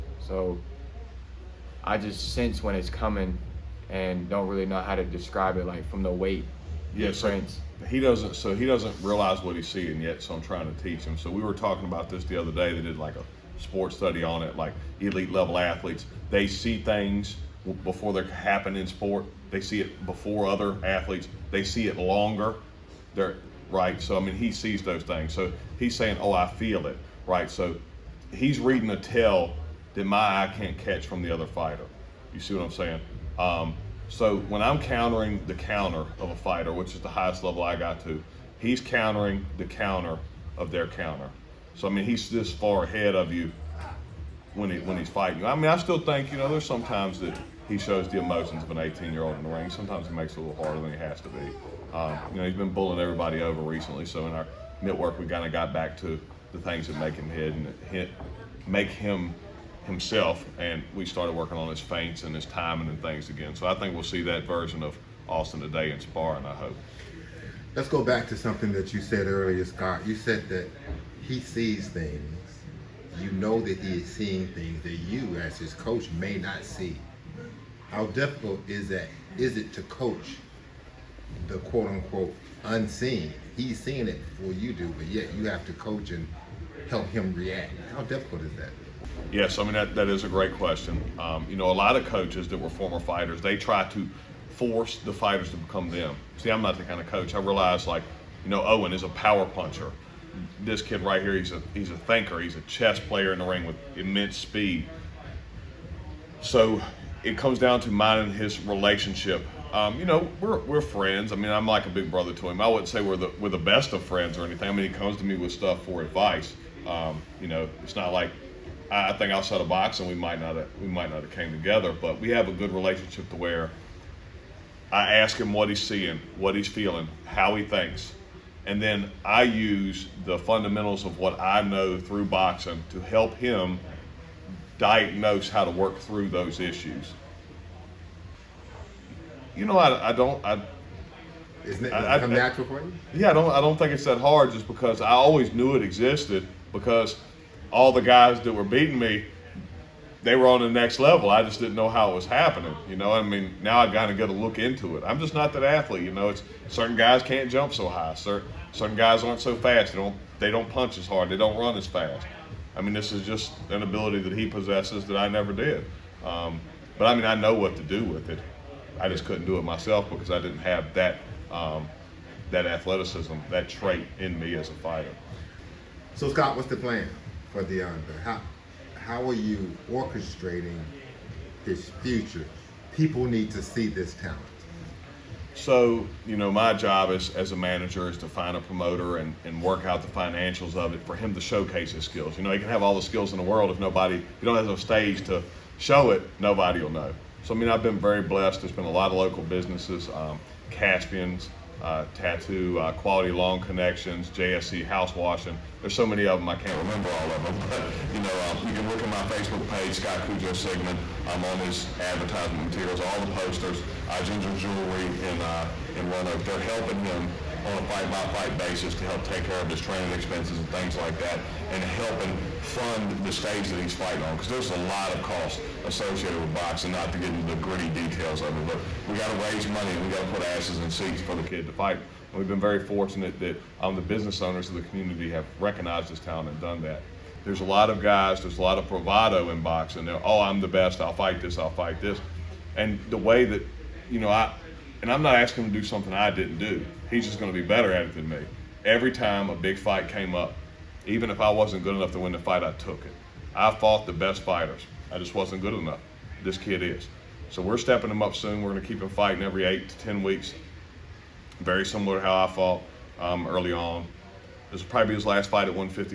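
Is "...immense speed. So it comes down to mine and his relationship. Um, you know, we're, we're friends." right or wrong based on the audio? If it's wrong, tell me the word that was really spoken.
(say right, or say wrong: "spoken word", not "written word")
right.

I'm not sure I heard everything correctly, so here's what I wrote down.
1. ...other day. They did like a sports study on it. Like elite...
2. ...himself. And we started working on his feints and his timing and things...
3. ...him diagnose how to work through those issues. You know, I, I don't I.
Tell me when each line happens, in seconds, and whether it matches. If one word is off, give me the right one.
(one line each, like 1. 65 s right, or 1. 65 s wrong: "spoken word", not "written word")
1. 12 s right
2. 59 s right
3. 133 s right.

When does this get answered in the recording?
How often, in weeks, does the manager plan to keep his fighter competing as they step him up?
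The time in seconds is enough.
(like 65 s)
259 s.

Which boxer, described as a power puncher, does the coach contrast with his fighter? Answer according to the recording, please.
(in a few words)
Owen.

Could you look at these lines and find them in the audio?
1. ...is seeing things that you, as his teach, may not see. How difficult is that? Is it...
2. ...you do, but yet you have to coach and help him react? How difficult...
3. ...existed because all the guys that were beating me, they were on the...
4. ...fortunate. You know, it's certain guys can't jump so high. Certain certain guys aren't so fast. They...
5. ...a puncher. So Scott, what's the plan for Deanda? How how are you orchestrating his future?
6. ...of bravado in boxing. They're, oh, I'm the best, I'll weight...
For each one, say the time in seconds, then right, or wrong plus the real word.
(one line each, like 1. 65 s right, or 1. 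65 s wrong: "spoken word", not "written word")
1. 74 s wrong: "coach", not "teach"
2. 84 s right
3. 145 s right
4. 155 s wrong: "athlete", not "fortunate"
5. 174 s wrong: "fighter", not "puncher"
6. 238 s wrong: "fight", not "weight".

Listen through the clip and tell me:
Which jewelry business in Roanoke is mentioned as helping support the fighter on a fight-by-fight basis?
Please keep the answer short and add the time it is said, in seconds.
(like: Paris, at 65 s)
Ginger Jewelry, at 214 s.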